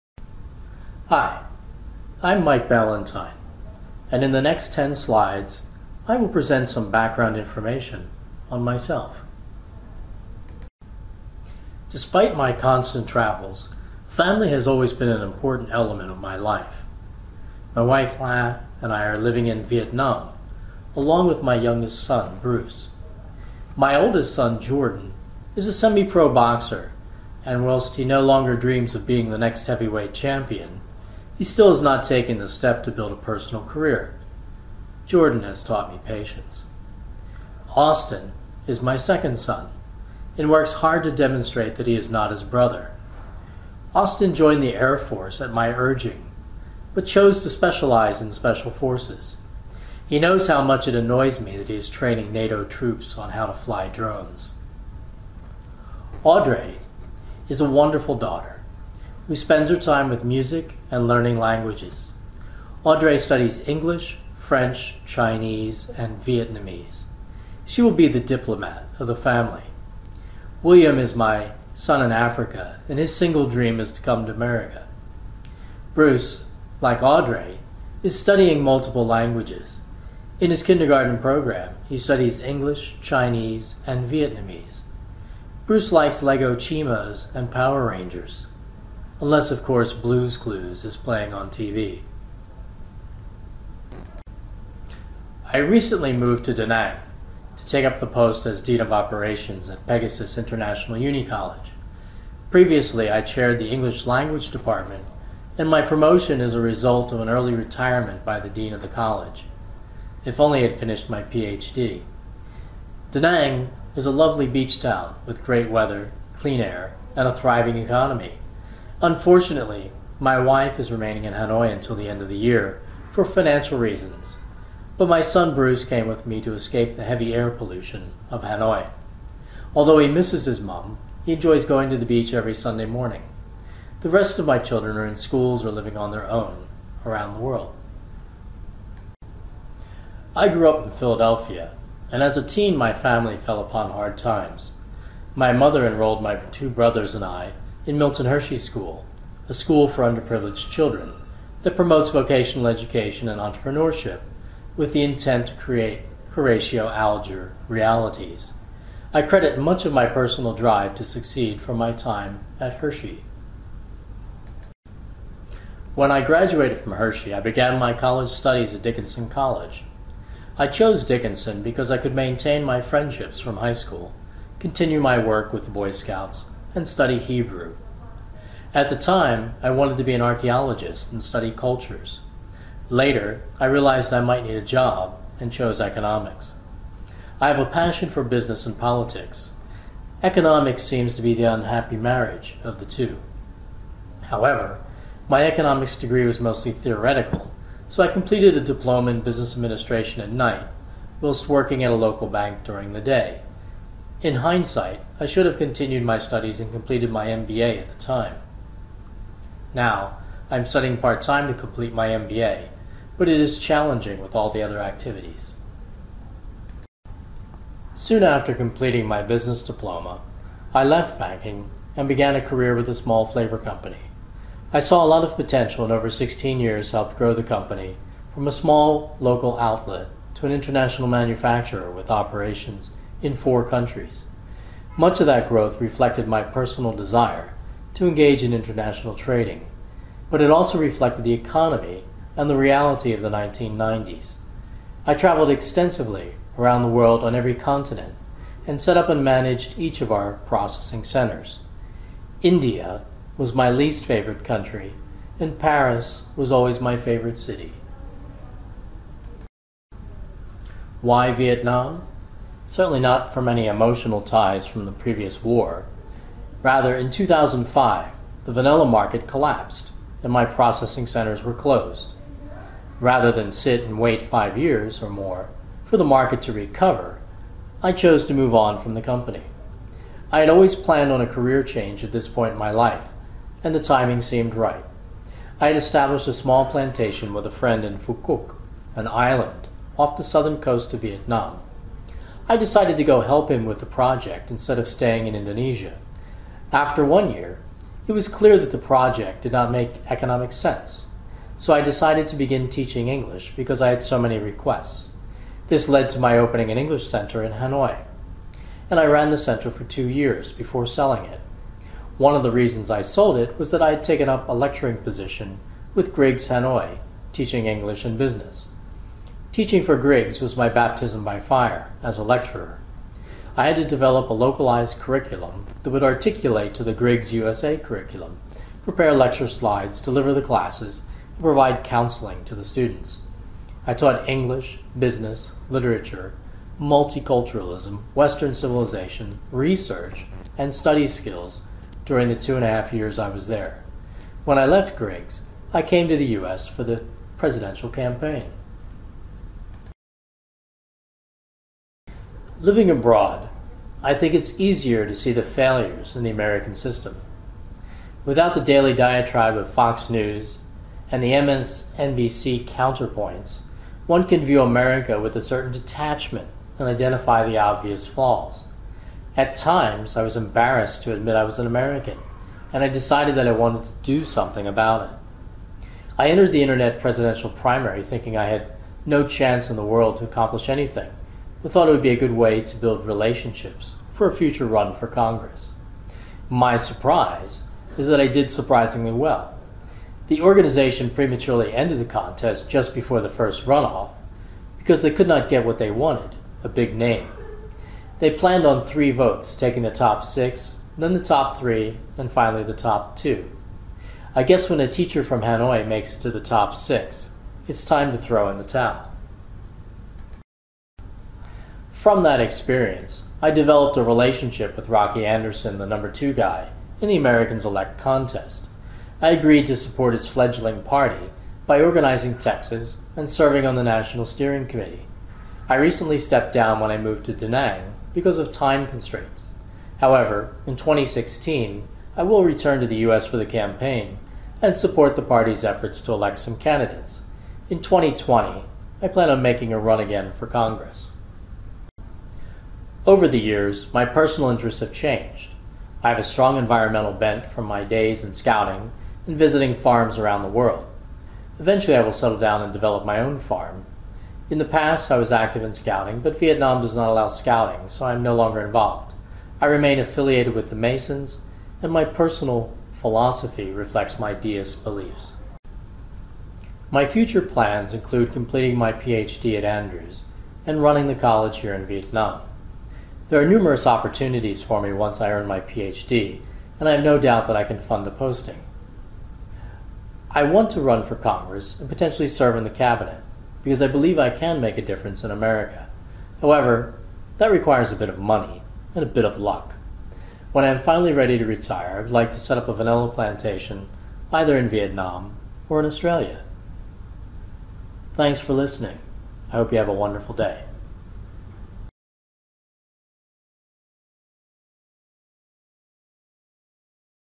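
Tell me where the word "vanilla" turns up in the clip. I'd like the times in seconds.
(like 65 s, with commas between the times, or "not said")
268 s, 492 s.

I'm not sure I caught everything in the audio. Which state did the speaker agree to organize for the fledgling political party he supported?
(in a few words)
Texas.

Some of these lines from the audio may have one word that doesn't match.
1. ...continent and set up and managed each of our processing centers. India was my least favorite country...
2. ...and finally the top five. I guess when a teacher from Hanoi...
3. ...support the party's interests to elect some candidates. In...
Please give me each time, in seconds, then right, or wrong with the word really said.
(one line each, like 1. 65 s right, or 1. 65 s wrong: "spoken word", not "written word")
1. 247 s right
2. 402 s wrong: "two", not "five"
3. 434 s wrong: "efforts", not "interests".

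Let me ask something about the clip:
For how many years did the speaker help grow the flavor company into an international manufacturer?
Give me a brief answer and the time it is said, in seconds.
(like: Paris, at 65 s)
16, at 226 s.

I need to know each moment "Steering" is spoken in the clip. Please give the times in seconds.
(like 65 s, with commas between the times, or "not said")
424 s.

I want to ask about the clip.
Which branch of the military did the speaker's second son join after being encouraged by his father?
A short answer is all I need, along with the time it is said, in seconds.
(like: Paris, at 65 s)
Air Force, at 44 s.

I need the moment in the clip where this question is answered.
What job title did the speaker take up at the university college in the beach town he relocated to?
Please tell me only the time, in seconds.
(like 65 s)
98 s.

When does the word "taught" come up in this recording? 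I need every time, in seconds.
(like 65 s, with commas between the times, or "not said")
35 s, 333 s.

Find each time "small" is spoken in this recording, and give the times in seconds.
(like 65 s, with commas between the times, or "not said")
222 s, 228 s, 286 s.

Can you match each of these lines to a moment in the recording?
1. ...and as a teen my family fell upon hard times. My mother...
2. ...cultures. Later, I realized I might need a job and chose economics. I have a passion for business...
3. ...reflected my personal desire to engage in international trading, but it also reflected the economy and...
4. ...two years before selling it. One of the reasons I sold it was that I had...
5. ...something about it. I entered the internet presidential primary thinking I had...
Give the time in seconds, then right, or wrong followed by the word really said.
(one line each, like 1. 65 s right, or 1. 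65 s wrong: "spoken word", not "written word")
1. 142 s right
2. 181 s right
3. 235 s right
4. 309 s right
5. 374 s right.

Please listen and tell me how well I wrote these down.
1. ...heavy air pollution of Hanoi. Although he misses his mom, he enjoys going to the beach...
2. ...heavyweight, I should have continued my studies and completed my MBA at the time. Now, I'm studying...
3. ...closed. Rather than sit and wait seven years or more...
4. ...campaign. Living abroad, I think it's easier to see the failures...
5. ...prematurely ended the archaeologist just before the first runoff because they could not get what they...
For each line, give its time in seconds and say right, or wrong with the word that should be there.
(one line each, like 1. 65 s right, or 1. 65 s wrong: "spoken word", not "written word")
1. 127 s right
2. 204 s wrong: "hindsight", not "heavyweight"
3. 271 s wrong: "five", not "seven"
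4. 347 s right
5. 391 s wrong: "contest", not "archaeologist".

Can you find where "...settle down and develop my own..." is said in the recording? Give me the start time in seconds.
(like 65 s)
452 s.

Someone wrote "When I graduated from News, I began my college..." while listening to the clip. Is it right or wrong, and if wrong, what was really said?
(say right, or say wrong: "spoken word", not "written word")
wrong: "Hershey", not "News".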